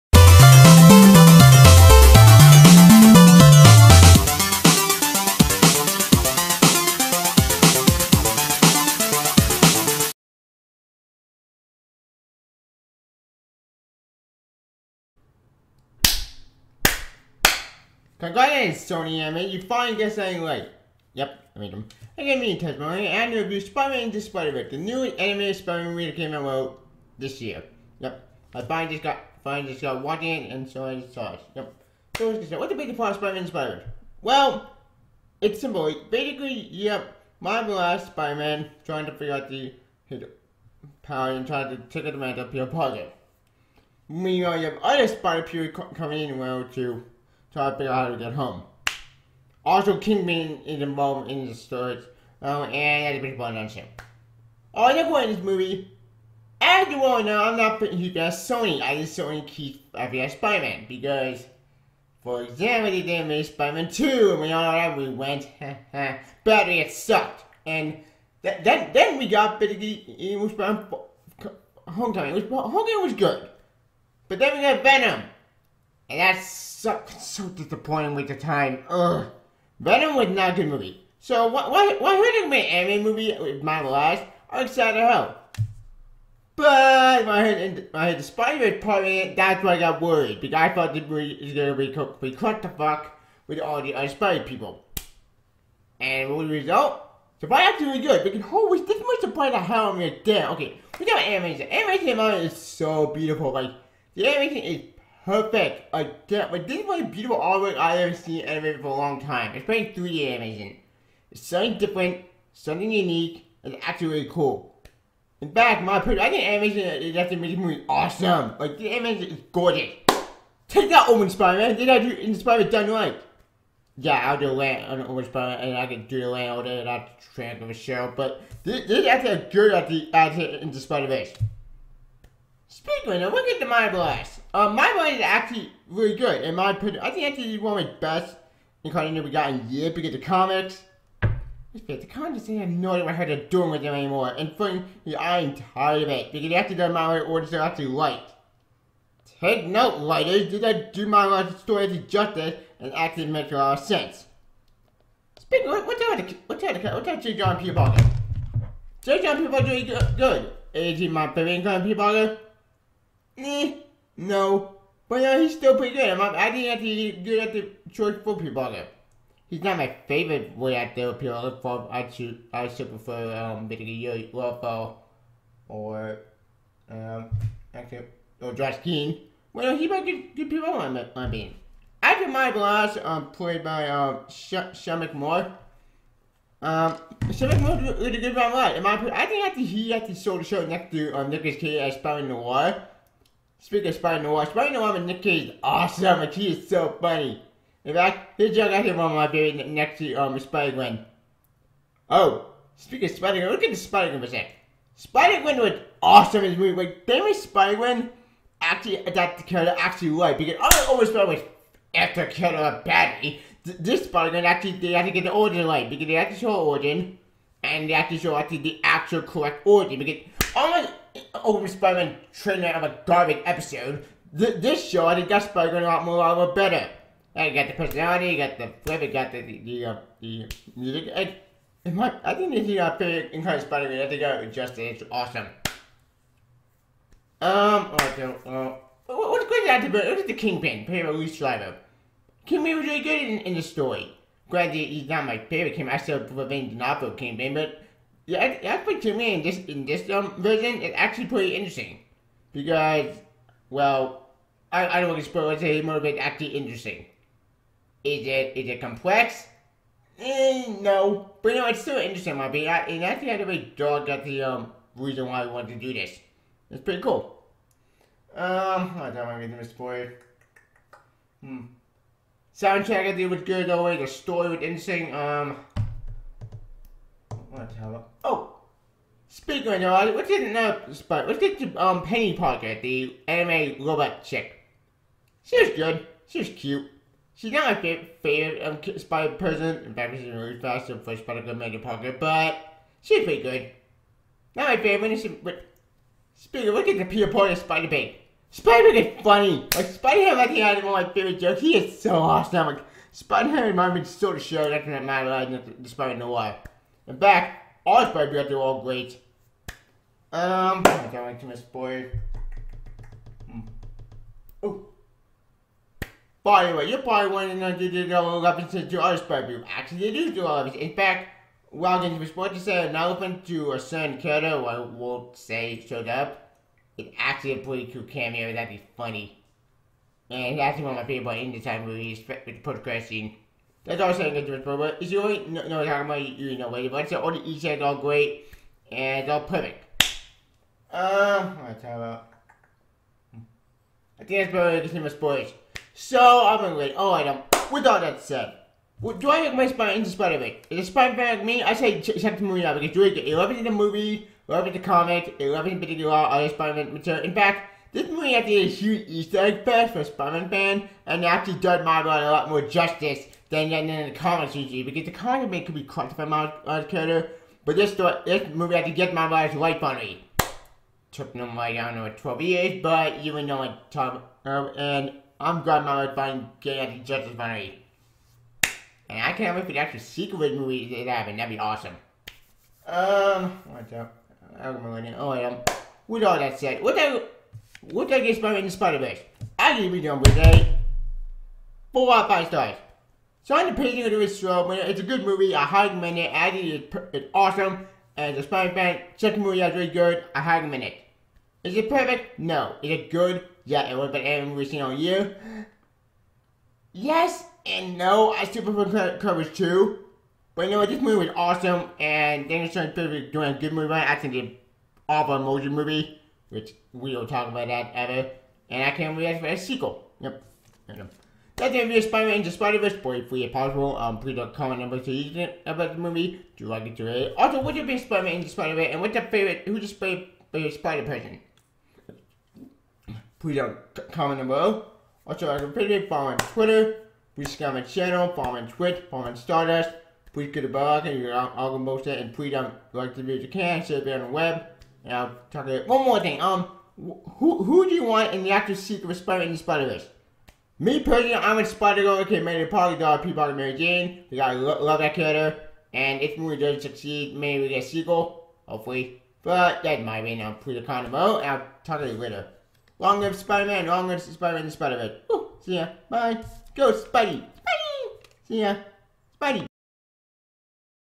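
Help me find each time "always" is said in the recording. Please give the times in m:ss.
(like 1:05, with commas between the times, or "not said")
3:30, 4:33.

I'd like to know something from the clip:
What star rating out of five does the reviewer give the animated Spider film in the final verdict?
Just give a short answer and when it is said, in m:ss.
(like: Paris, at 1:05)
4 out of 5, at 6:31.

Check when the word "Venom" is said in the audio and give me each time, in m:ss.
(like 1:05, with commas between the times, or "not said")
1:14, 1:19.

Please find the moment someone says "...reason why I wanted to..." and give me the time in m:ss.
4:24.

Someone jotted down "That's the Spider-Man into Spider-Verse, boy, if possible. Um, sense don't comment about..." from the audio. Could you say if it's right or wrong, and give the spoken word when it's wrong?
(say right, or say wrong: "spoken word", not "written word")
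wrong: "please", not "sense".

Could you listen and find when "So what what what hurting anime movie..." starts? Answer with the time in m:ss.
1:21.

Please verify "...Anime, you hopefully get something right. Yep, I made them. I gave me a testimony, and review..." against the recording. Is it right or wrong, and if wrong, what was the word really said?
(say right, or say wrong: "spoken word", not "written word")
wrong: "finally", not "hopefully".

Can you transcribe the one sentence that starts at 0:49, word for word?
Also, Kingpin is involved in the story, um, and that's a big fun on him.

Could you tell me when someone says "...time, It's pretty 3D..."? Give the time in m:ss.
1:49.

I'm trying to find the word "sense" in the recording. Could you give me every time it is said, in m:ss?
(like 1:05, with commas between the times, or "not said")
2:33.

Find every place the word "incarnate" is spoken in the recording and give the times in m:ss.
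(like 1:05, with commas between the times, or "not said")
2:18, 2:41, 3:53.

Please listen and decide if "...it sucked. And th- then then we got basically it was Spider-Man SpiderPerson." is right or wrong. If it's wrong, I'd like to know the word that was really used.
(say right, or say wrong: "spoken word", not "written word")
wrong: "Homecoming", not "SpiderPerson".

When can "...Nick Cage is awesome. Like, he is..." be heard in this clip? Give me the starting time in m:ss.
3:15.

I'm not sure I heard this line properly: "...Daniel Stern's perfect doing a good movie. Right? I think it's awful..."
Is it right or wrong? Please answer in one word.
right.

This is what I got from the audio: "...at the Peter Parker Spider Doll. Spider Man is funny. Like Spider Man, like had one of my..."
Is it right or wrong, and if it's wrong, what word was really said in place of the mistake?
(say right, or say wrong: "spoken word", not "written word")
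wrong: "Man", not "Doll".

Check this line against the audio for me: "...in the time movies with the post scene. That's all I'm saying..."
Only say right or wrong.
right.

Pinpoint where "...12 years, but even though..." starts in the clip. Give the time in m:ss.
6:12.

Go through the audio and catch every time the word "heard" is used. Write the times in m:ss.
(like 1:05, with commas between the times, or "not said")
1:28.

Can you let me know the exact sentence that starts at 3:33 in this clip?
This Spider-Gwen actually, they actually get the origin right.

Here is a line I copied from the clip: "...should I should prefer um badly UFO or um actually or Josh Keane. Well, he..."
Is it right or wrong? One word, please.
wrong.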